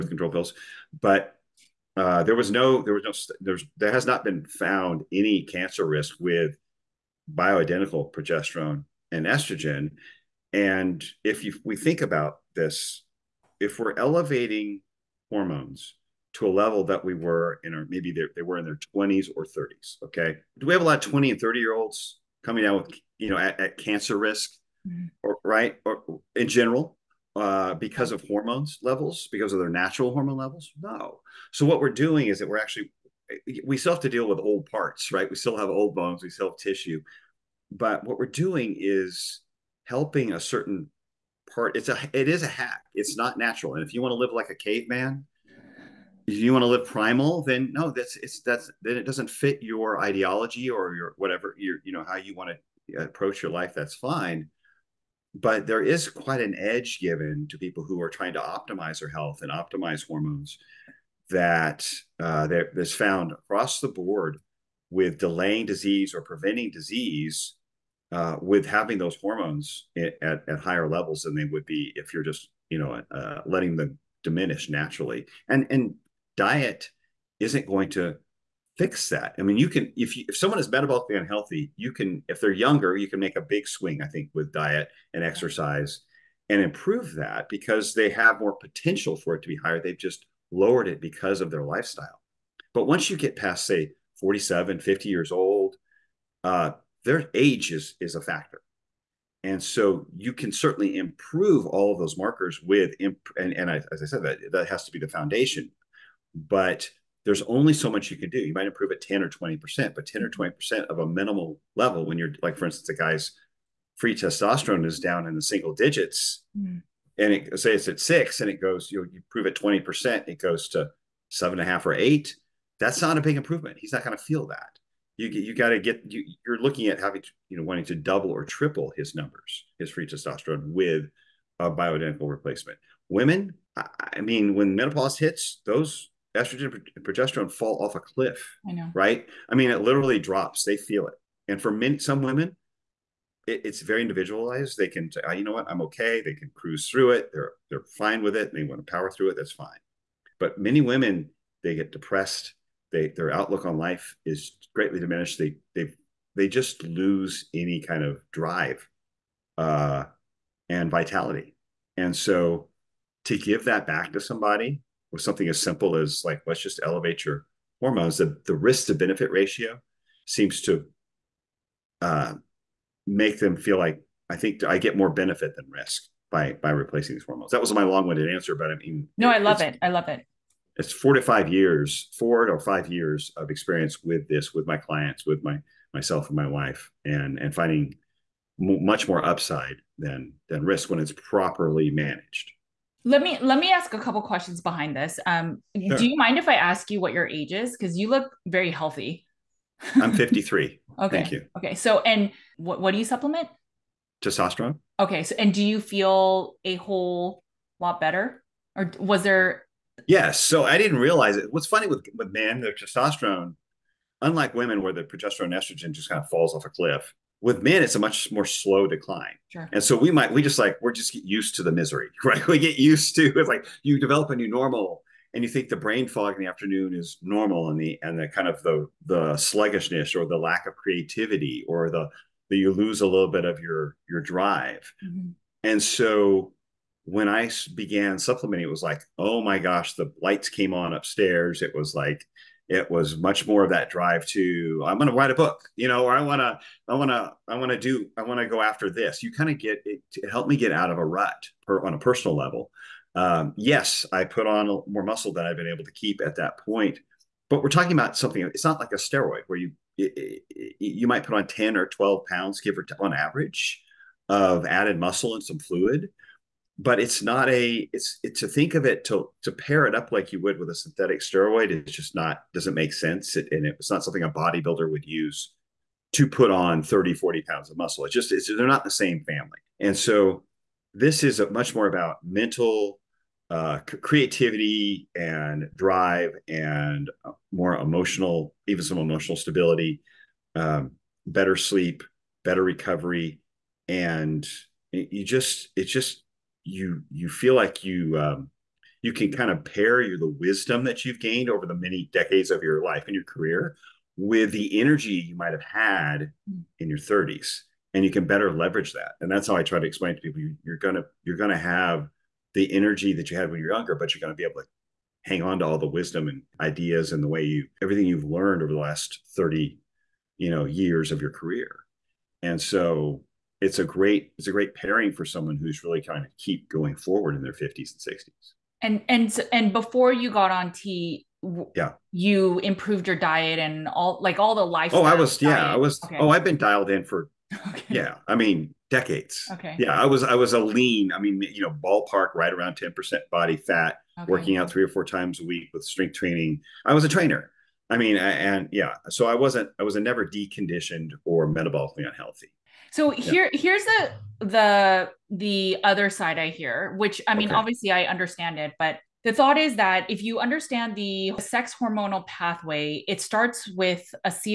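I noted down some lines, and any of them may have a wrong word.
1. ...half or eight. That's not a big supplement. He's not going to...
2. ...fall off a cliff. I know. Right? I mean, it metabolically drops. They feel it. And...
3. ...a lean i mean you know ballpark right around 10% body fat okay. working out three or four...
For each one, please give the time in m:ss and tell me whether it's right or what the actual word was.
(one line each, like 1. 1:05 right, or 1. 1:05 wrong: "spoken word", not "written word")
1. 2:01 wrong: "improvement", not "supplement"
2. 2:17 wrong: "literally", not "metabolically"
3. 5:40 right.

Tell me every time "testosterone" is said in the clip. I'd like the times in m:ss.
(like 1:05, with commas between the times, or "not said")
1:54, 2:10, 3:24, 3:32.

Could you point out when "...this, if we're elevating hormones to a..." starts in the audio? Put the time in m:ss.
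0:12.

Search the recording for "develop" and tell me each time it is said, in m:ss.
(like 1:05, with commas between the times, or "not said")
3:43.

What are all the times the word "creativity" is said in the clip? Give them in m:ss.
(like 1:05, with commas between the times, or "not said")
3:50, 4:44.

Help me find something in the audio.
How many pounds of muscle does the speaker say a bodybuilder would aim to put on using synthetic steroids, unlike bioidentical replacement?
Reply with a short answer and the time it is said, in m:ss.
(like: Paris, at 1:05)
30 to 40 pounds, at 4:36.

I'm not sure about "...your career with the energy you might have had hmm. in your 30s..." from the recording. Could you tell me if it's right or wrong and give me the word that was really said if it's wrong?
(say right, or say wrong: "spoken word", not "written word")
right.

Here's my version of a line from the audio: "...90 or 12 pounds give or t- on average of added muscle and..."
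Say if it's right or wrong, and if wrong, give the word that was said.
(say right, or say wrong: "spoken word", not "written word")
wrong: "10", not "90".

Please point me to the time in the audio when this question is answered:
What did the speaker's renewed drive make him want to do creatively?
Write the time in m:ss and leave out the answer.
4:05.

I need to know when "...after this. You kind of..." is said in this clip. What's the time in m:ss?
4:08.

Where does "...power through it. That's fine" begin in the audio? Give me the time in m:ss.
2:28.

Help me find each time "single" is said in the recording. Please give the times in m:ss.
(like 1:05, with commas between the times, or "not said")
1:55.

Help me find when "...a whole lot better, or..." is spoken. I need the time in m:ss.
3:26.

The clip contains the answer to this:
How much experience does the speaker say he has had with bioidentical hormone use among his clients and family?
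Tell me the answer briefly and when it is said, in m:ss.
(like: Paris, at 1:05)
4 to 5 years, at 3:00.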